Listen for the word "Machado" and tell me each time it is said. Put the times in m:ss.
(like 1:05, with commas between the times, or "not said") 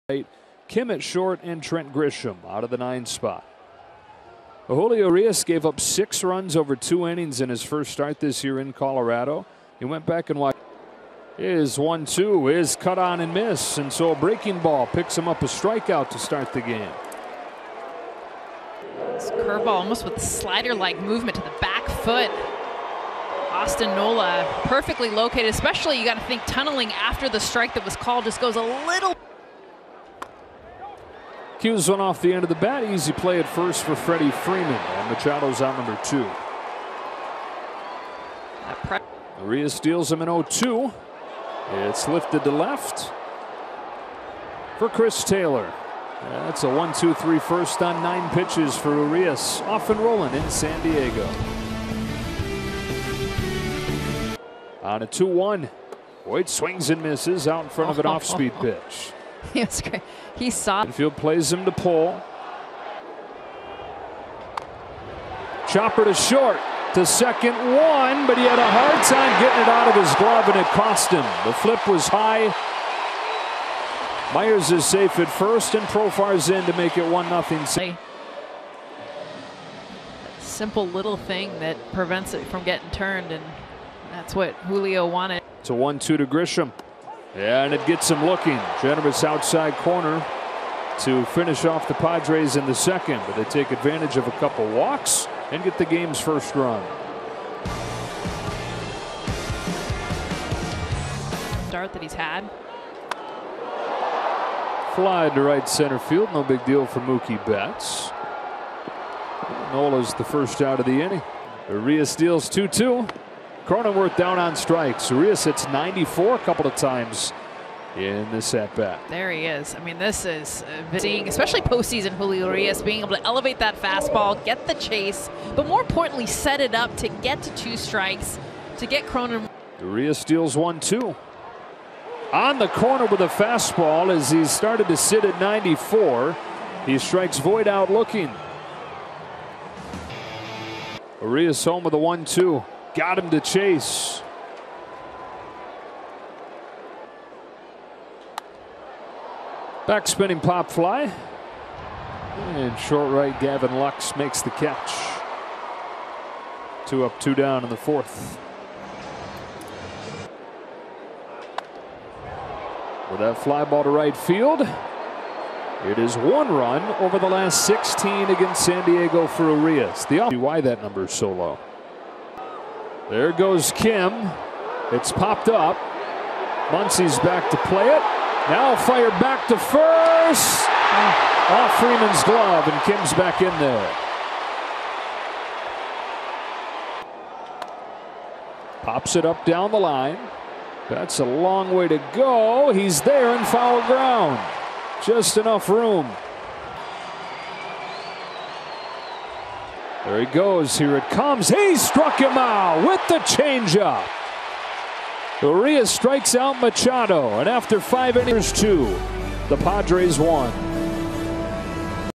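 0:35, 3:26.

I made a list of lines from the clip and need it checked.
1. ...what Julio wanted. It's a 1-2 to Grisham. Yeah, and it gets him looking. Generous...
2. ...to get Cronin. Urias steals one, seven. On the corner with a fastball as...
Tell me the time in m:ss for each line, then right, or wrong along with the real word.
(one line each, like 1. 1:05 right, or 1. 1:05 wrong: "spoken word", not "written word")
1. 1:24 right
2. 2:08 wrong: "two", not "seven".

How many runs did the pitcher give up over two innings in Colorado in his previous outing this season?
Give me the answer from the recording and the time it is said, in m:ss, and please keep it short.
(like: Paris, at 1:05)
6, at 0:05.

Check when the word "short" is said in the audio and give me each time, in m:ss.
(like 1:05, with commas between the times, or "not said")
0:01, 1:06, 2:32.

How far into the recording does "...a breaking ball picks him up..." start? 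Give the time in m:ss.
0:14.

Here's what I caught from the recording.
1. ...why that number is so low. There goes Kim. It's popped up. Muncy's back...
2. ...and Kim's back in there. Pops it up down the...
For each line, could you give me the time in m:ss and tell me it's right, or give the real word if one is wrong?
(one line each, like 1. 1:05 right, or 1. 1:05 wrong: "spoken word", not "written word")
1. 2:50 right
2. 3:02 right.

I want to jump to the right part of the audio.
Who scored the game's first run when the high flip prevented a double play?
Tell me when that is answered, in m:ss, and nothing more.
1:15.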